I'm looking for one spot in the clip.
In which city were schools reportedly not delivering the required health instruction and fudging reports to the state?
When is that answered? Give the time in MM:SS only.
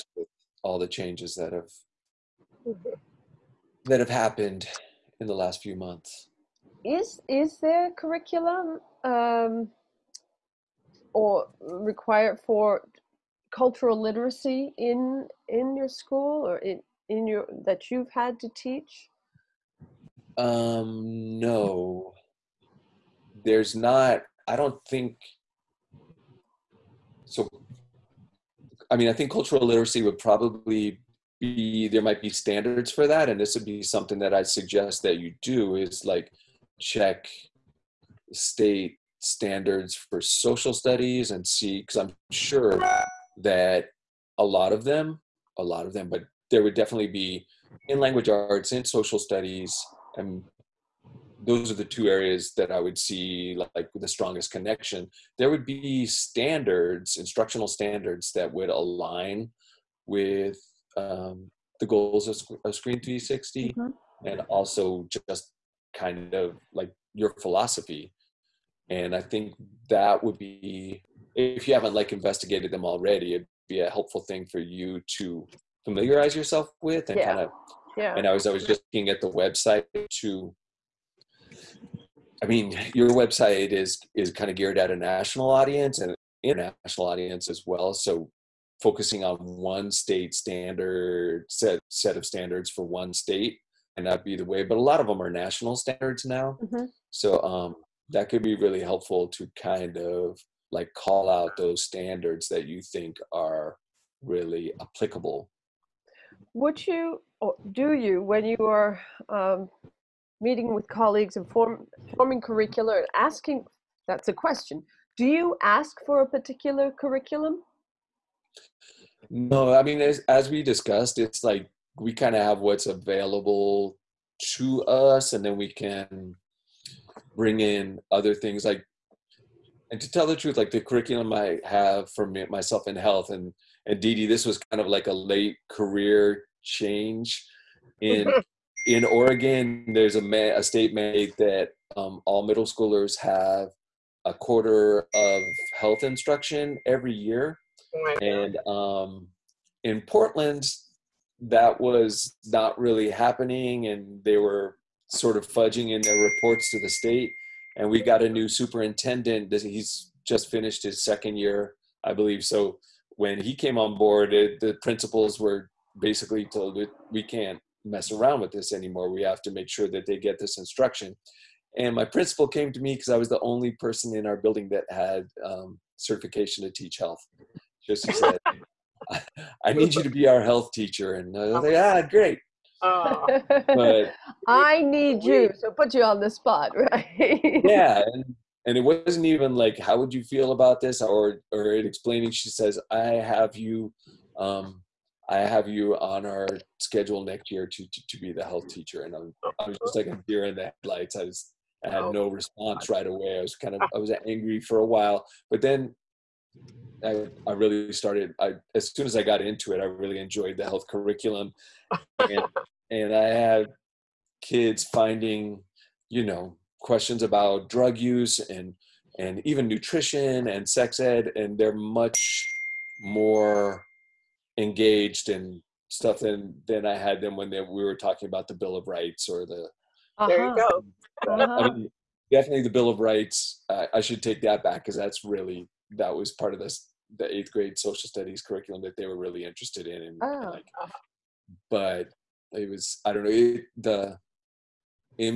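02:30.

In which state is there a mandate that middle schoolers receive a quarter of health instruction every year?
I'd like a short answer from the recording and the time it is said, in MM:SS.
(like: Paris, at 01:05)
Oregon, at 02:19.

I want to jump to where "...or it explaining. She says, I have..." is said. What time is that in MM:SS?
03:11.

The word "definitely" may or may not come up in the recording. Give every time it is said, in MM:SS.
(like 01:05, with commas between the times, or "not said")
00:46, 03:52.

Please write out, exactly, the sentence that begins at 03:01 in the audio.
And I uh, was like, ah, great.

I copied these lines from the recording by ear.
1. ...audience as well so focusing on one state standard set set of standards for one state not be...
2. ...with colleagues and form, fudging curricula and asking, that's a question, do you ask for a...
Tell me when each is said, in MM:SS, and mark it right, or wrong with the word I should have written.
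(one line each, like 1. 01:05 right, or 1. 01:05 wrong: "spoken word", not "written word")
1. 01:27 right
2. 01:50 wrong: "forming", not "fudging".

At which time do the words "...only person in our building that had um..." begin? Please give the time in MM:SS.
02:53.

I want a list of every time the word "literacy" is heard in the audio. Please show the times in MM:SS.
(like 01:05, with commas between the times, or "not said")
00:14, 00:29.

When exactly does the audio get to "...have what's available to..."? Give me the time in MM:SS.
02:02.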